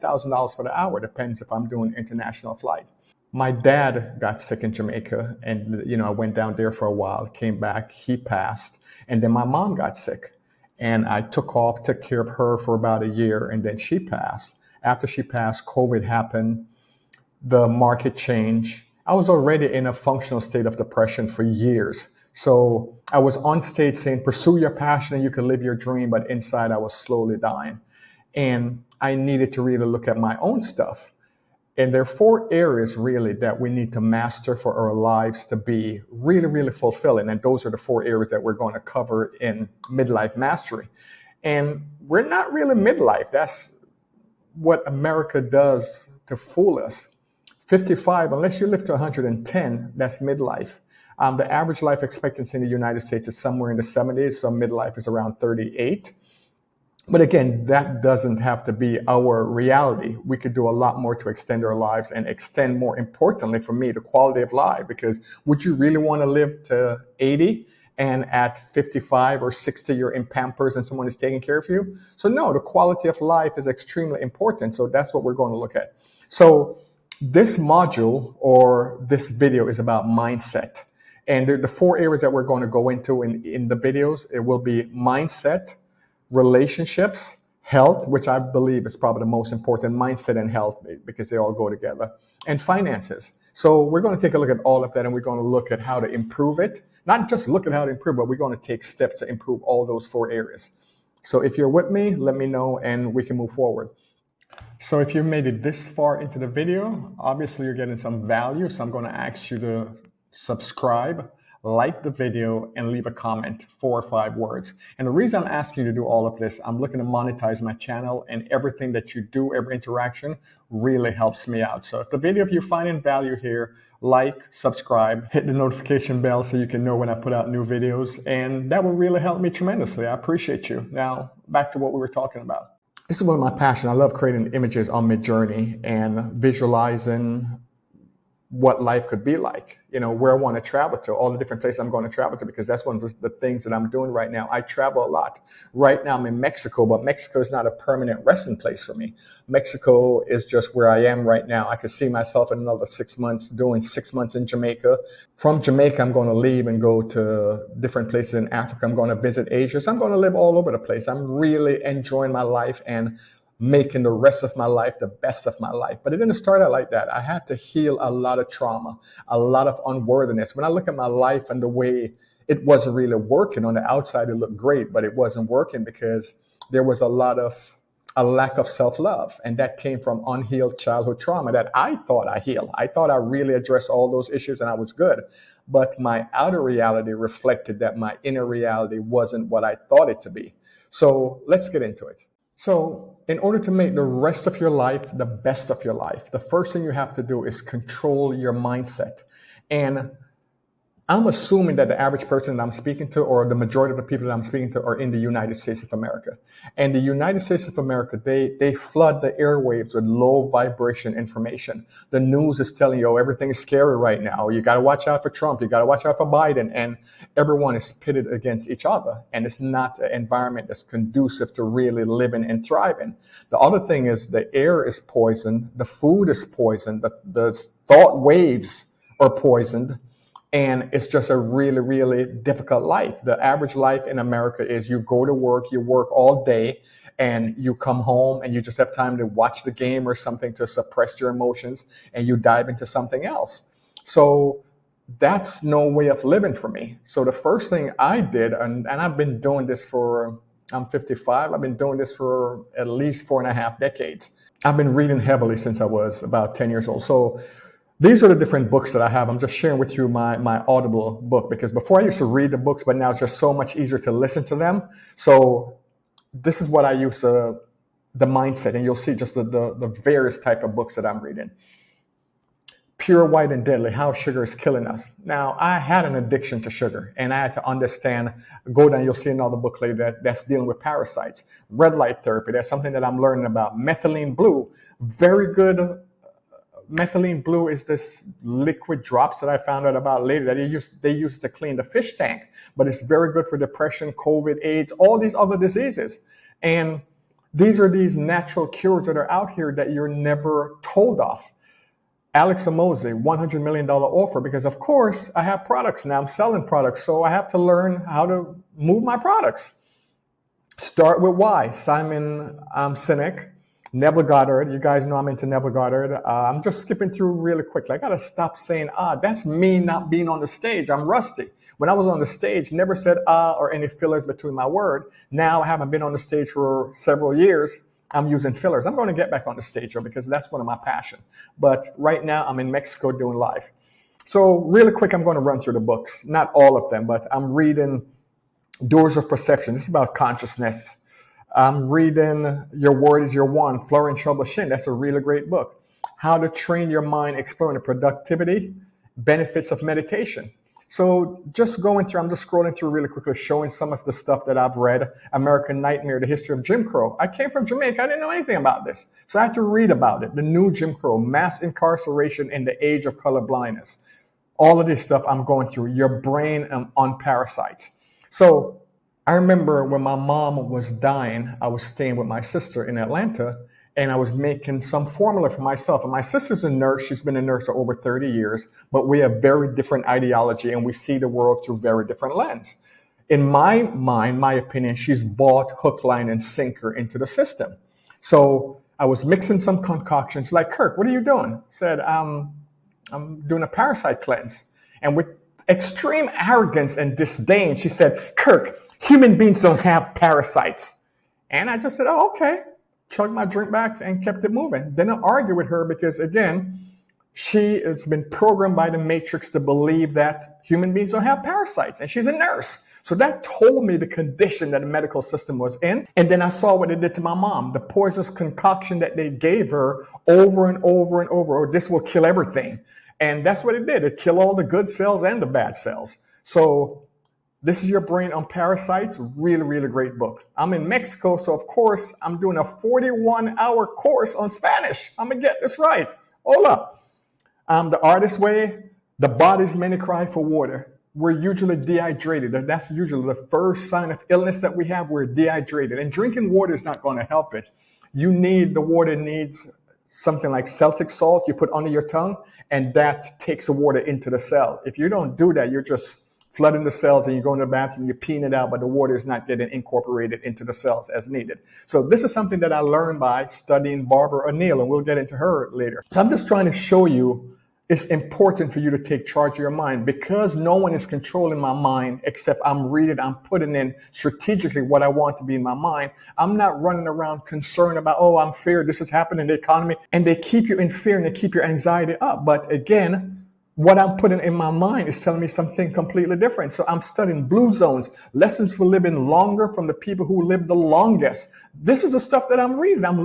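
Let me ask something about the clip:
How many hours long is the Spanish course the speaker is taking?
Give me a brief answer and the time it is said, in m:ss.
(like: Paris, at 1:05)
41, at 7:12.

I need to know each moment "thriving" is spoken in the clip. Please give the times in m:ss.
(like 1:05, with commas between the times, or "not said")
3:42.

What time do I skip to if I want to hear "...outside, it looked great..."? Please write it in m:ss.
2:53.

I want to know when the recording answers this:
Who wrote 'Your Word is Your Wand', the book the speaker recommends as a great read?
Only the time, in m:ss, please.
5:43.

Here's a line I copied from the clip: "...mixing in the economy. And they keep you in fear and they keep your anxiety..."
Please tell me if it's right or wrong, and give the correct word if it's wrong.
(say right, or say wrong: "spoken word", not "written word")
wrong: "happening", not "mixing".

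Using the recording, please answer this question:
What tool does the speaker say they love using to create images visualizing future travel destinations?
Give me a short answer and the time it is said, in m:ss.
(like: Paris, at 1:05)
Midjourney, at 2:15.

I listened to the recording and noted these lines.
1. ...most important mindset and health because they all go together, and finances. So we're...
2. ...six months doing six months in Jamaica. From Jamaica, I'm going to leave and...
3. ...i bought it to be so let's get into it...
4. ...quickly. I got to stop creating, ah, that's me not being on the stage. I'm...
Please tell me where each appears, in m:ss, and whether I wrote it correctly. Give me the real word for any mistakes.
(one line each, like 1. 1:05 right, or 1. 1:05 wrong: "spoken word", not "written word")
1. 1:29 right
2. 2:32 right
3. 3:09 wrong: "thought", not "bought"
4. 5:17 wrong: "saying", not "creating".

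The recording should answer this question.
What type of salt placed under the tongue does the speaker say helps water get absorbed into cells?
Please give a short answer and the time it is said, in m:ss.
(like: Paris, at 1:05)
Celtic salt, at 7:30.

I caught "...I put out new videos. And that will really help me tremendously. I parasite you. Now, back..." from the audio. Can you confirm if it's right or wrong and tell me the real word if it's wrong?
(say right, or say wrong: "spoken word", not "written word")
wrong: "appreciate", not "parasite".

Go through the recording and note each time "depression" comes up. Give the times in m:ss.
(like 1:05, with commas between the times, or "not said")
0:20, 4:53.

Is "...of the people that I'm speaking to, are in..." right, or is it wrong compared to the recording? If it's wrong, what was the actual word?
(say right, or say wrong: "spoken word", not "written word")
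right.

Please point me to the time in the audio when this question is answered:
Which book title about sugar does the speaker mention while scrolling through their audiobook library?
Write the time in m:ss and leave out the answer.
4:32.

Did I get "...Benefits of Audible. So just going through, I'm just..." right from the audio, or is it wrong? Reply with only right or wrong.
wrong.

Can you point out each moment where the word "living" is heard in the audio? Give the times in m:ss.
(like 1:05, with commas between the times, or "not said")
3:42, 4:06, 8:08.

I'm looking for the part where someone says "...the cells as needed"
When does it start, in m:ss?
7:40.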